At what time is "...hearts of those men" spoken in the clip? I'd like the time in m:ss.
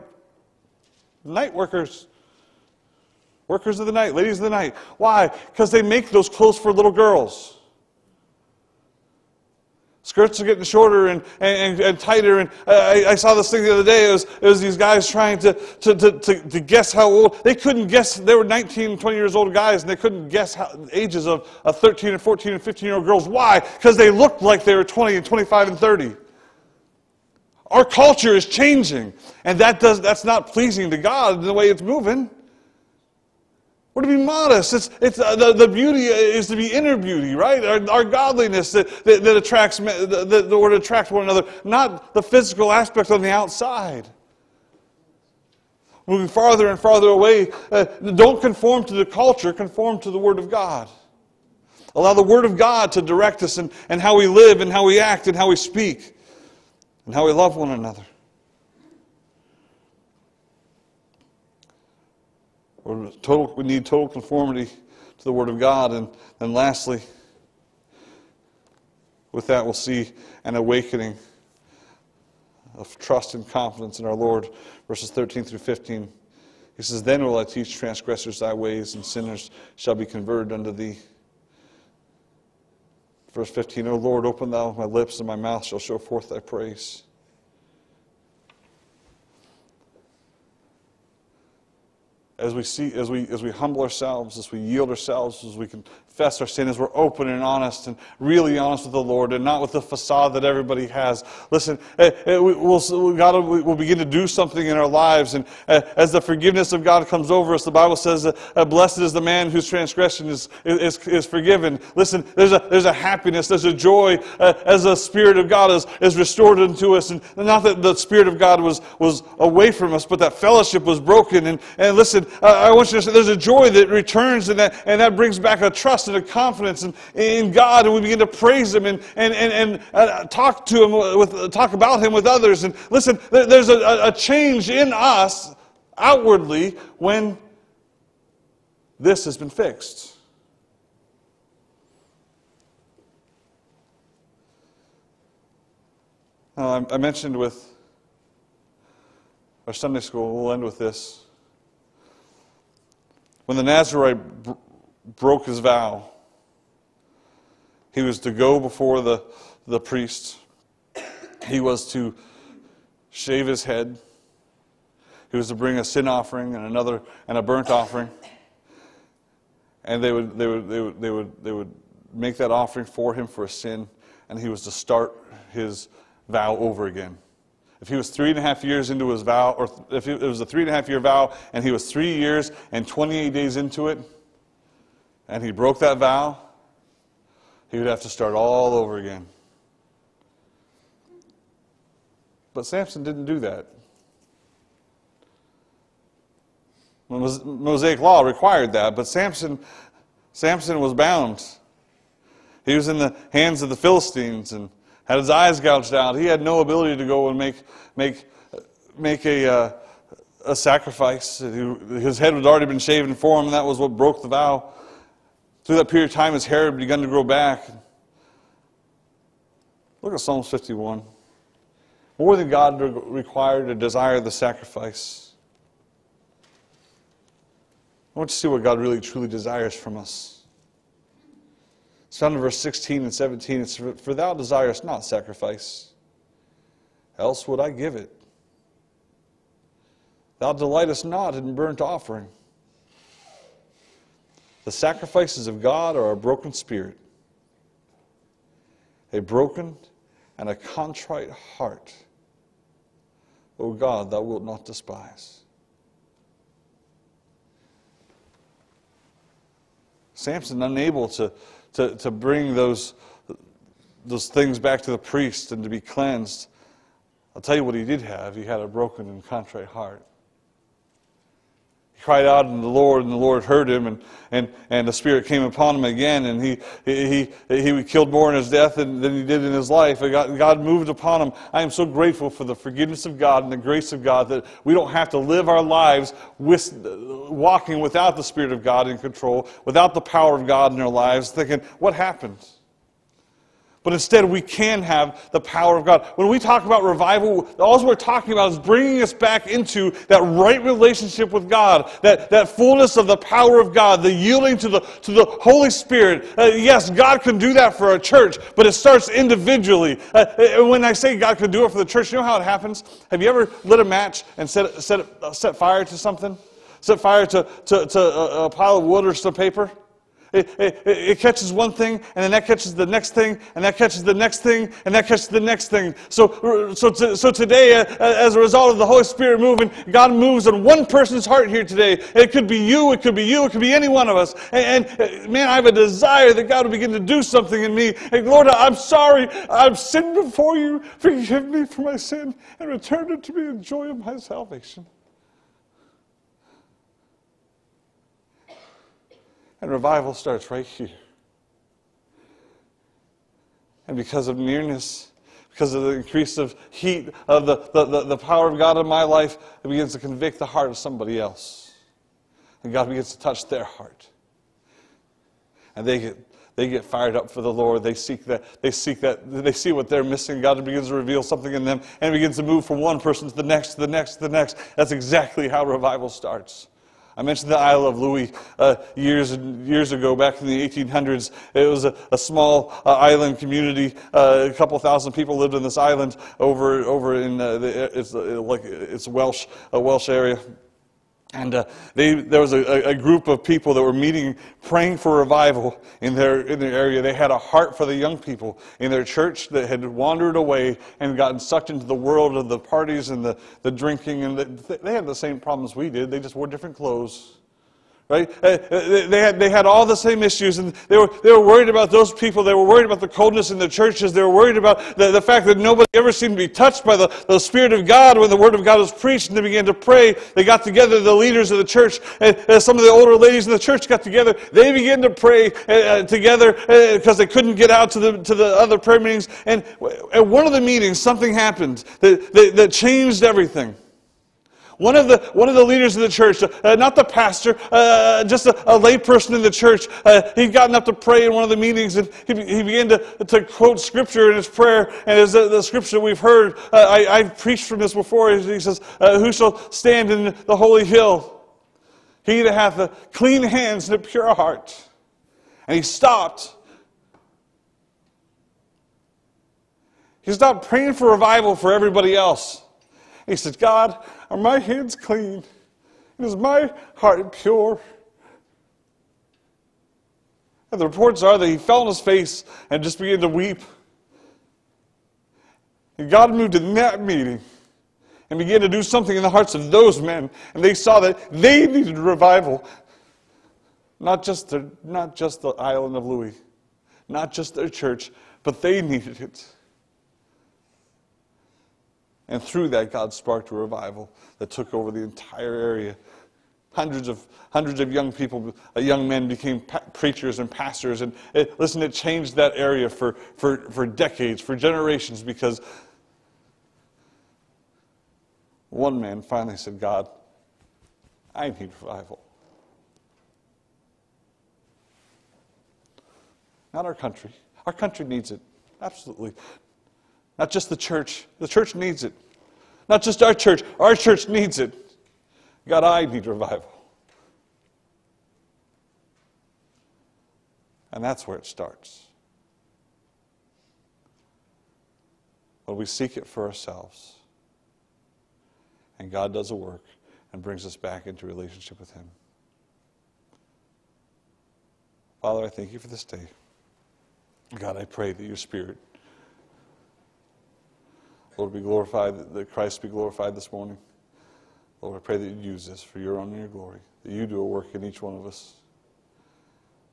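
7:59.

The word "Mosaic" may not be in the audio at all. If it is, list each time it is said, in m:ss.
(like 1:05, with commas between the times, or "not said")
3:17.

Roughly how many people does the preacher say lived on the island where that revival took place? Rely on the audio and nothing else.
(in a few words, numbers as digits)
a couple thousand.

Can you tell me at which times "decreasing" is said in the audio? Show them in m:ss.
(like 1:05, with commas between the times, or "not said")
not said.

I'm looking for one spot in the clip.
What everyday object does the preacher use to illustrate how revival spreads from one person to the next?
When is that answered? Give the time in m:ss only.
5:13.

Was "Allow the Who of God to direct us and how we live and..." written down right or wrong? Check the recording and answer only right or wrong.
wrong.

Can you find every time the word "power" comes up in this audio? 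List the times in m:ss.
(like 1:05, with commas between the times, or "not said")
4:50, 4:55, 5:03, 5:58.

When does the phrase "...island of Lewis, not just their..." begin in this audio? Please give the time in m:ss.
8:05.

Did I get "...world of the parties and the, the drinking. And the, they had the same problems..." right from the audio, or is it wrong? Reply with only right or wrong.
right.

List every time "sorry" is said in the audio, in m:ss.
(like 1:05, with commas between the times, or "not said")
5:38.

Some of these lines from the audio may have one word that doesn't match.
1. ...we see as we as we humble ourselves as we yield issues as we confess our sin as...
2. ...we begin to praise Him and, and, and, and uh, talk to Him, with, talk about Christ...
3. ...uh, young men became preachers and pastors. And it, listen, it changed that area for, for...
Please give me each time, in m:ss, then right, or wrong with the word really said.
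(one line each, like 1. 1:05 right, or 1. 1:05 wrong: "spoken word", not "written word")
1. 1:32 wrong: "ourselves", not "issues"
2. 2:07 wrong: "Him", not "Christ"
3. 8:18 right.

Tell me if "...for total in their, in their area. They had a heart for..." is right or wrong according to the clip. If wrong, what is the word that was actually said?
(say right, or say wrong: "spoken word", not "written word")
wrong: "revival", not "total".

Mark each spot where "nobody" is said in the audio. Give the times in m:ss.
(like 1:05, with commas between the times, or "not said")
6:55.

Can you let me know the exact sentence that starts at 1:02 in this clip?
total, we need total conformity to the Word of God.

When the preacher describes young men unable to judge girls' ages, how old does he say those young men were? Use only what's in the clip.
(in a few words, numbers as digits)
19, 20.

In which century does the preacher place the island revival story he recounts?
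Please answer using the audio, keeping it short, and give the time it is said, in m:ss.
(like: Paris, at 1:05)
the 1800s, at 6:20.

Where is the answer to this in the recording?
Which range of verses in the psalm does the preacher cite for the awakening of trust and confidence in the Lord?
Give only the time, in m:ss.
1:14.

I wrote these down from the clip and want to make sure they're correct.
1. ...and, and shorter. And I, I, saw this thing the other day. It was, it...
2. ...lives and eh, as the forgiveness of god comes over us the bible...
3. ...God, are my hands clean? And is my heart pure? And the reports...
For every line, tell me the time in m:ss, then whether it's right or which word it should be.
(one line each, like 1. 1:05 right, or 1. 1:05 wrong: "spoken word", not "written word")
1. 0:11 wrong: "tighter", not "shorter"
2. 1:44 right
3. 7:43 right.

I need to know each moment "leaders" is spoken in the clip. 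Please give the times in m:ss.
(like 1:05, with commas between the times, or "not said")
7:01, 7:15.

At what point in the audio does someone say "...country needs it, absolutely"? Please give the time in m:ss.
8:37.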